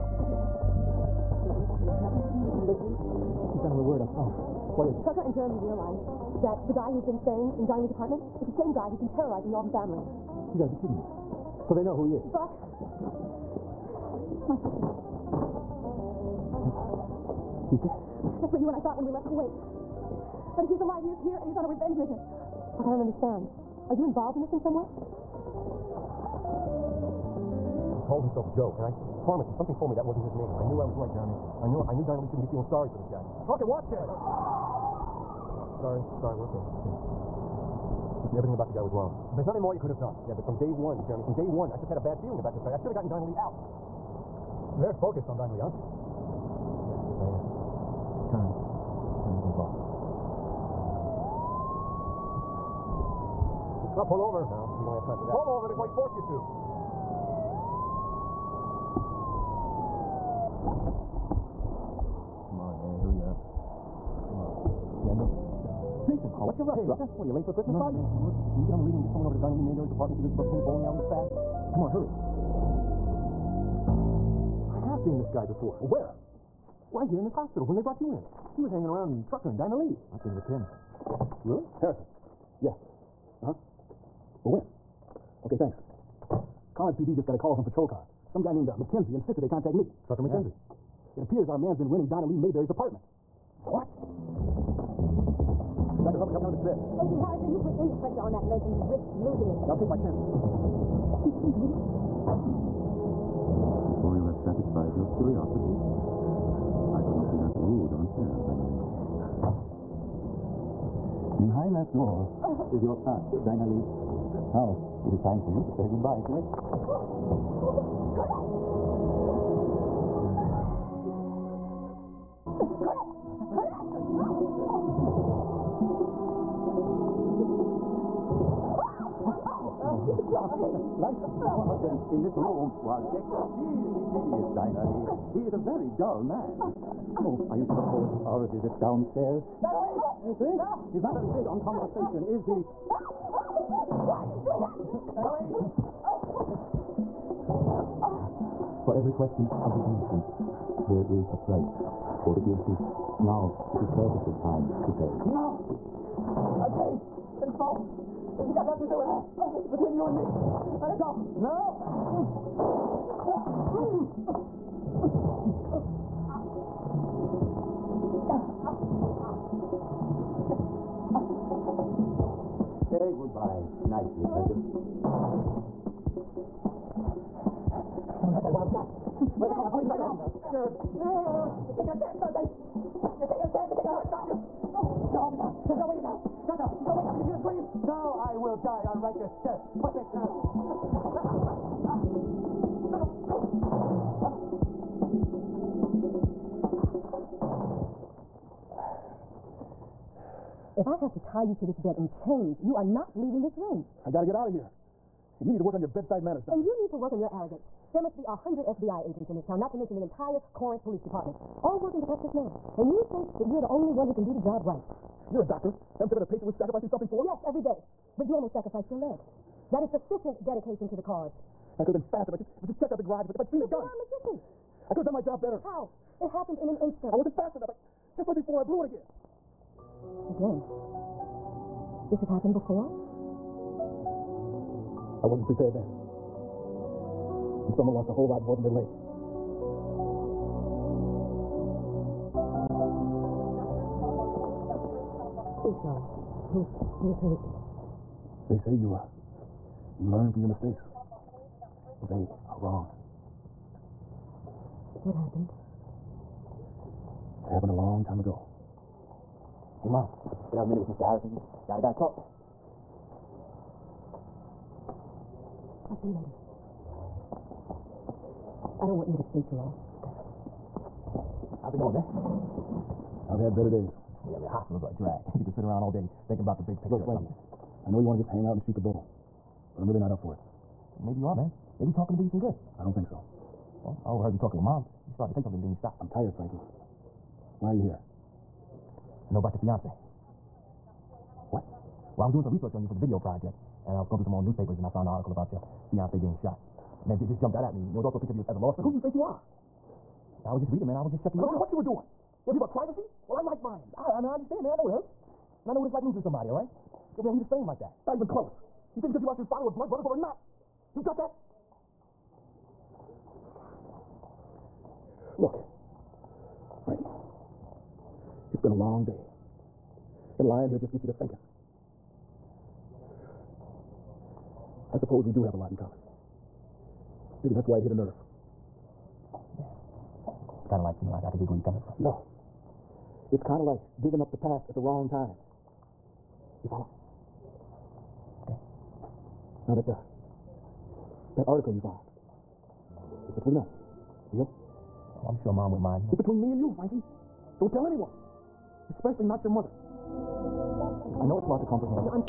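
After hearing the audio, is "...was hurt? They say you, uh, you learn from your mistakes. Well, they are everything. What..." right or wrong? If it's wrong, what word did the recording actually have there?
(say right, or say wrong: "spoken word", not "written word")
wrong: "wrong", not "everything".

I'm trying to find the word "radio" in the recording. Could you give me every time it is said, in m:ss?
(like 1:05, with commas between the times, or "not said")
1:08.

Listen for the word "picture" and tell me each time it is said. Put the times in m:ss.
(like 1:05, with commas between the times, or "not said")
4:36, 4:58.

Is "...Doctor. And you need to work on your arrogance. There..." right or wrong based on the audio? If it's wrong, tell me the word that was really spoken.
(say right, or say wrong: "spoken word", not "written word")
right.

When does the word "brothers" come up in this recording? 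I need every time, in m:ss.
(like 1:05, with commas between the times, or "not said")
5:09.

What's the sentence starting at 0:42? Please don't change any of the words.
I should have gotten Donnelly out.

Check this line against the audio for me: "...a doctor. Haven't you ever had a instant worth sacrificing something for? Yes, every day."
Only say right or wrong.
wrong.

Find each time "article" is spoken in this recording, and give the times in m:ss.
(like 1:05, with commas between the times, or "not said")
4:55, 5:41.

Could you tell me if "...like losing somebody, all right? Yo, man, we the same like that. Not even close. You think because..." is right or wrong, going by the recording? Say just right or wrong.
right.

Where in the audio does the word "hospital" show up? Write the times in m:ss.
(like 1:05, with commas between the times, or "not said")
1:17, 4:34.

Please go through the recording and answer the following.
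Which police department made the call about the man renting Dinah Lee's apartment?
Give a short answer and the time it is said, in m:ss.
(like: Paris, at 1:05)
Corinth PD, at 1:26.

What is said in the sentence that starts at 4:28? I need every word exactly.
I don't want you to stay too long.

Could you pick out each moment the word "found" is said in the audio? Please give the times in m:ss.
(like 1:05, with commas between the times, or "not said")
4:54, 5:41.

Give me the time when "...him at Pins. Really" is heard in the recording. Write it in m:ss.
1:20.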